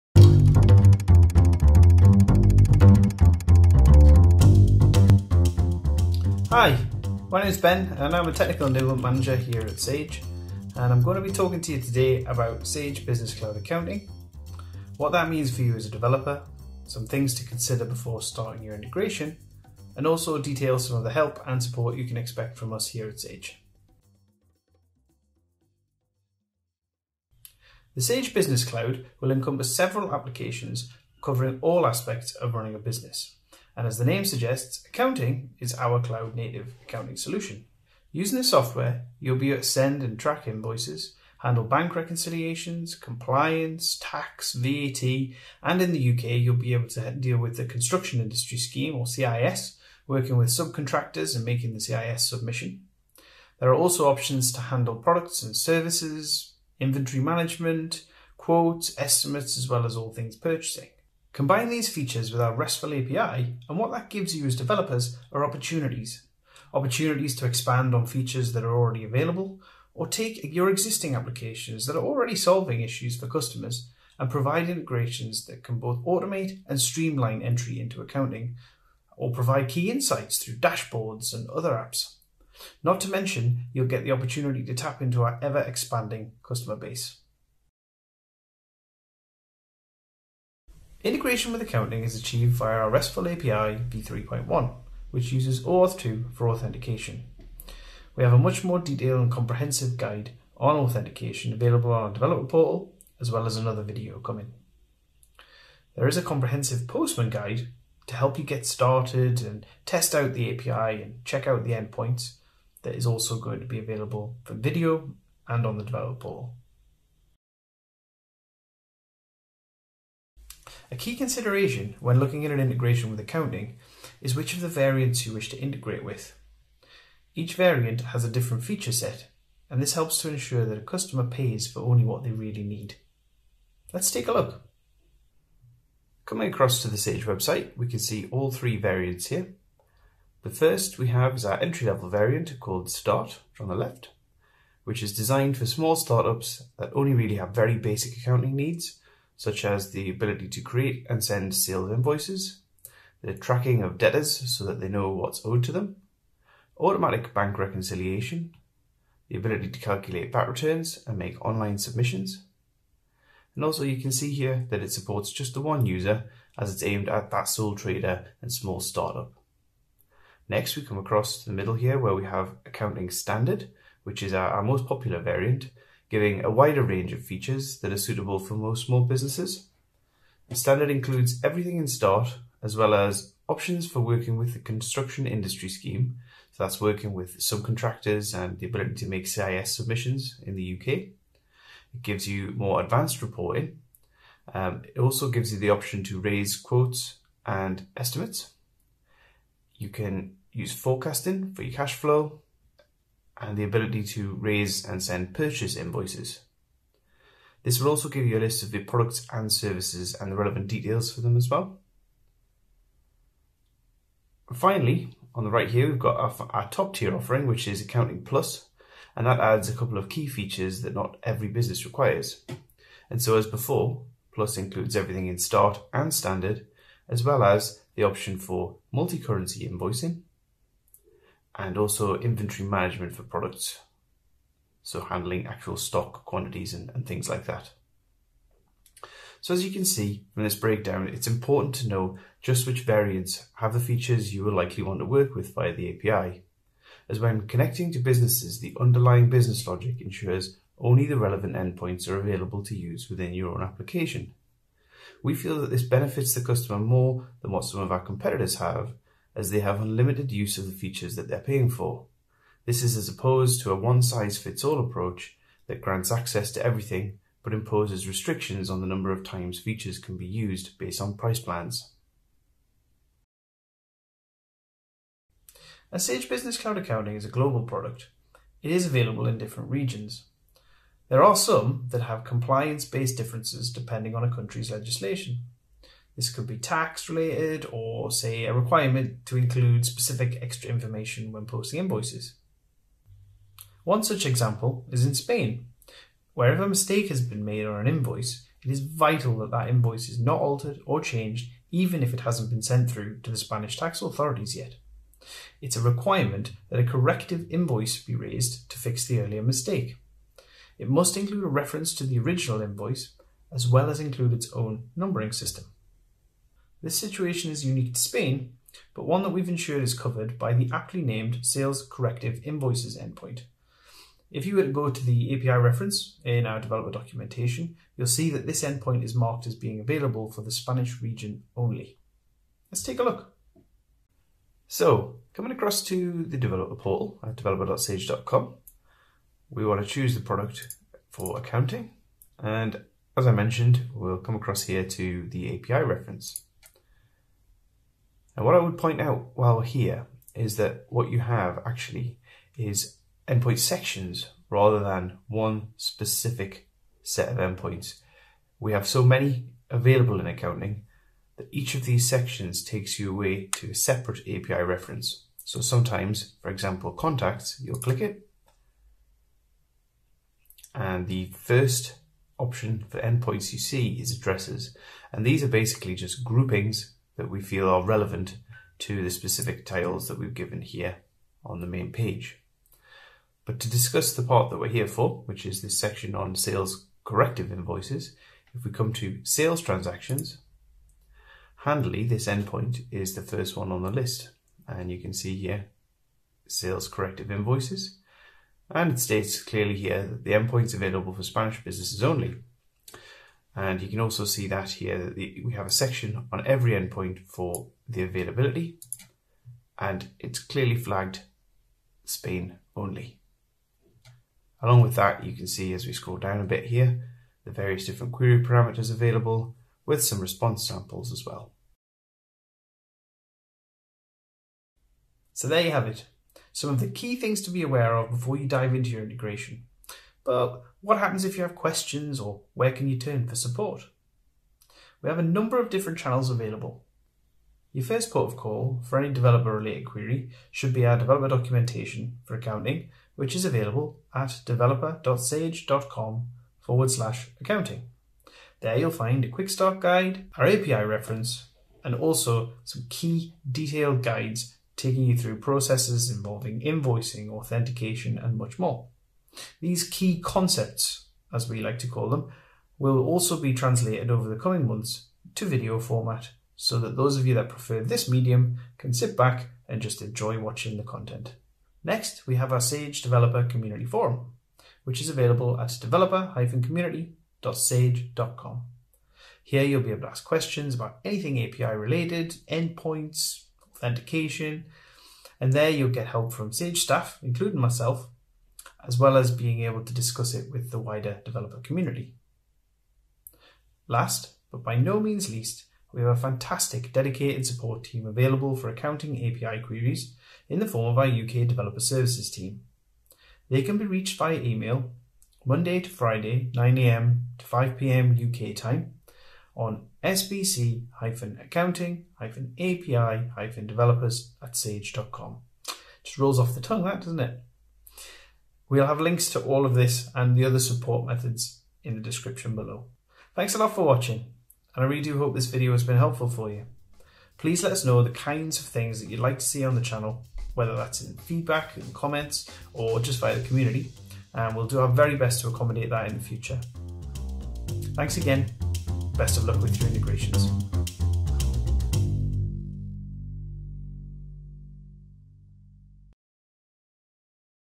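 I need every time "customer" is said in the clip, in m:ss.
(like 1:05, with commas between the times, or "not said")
1:13, 1:26, 2:10, 4:16.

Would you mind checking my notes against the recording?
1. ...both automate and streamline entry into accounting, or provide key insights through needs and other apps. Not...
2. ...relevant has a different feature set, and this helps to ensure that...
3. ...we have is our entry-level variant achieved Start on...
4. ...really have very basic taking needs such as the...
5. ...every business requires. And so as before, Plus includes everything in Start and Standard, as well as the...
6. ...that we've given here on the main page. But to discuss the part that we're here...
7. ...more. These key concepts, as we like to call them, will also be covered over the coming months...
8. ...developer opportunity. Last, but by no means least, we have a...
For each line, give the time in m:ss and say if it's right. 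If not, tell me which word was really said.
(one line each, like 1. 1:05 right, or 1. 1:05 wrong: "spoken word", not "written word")
1. 1:15 wrong: "dashboards", not "needs"
2. 2:07 wrong: "variant", not "relevant"
3. 2:20 wrong: "called", not "achieved"
4. 2:27 wrong: "accounting", not "taking"
5. 3:41 right
6. 6:20 right
7. 7:38 wrong: "translated", not "covered"
8. 8:11 wrong: "community", not "opportunity".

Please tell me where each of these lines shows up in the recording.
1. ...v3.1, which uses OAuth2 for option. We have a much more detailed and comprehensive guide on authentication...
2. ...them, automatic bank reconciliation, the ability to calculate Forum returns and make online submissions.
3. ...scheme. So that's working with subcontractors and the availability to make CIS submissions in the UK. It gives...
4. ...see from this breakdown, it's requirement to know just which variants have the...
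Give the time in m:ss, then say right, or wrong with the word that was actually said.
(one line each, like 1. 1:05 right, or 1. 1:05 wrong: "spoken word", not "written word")
1. 1:33 wrong: "authentication", not "option"
2. 2:35 wrong: "VAT", not "Forum"
3. 3:05 wrong: "ability", not "availability"
4. 3:59 wrong: "important", not "requirement".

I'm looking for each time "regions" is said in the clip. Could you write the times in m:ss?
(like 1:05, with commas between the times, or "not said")
4:39, 5:31.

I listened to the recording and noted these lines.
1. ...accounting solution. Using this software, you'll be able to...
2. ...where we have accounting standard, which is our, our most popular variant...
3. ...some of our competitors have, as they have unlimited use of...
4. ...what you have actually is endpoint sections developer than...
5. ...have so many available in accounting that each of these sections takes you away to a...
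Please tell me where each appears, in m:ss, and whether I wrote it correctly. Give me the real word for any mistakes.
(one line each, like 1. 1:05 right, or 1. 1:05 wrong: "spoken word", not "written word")
1. 0:36 right
2. 2:51 right
3. 4:17 right
4. 5:50 wrong: "rather", not "developer"
5. 5:58 right.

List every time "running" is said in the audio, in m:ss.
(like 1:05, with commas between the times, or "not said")
0:32.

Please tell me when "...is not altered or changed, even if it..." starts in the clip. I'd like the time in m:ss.
5:00.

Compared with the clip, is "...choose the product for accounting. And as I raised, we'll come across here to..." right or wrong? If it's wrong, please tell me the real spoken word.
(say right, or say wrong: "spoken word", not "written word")
wrong: "mentioned", not "raised".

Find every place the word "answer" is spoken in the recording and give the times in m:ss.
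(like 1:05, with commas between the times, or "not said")
not said.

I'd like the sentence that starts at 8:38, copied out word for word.
We'll have links to all of this and the other support methods in the description below.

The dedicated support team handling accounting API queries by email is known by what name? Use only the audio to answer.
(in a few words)
UK Developer Services.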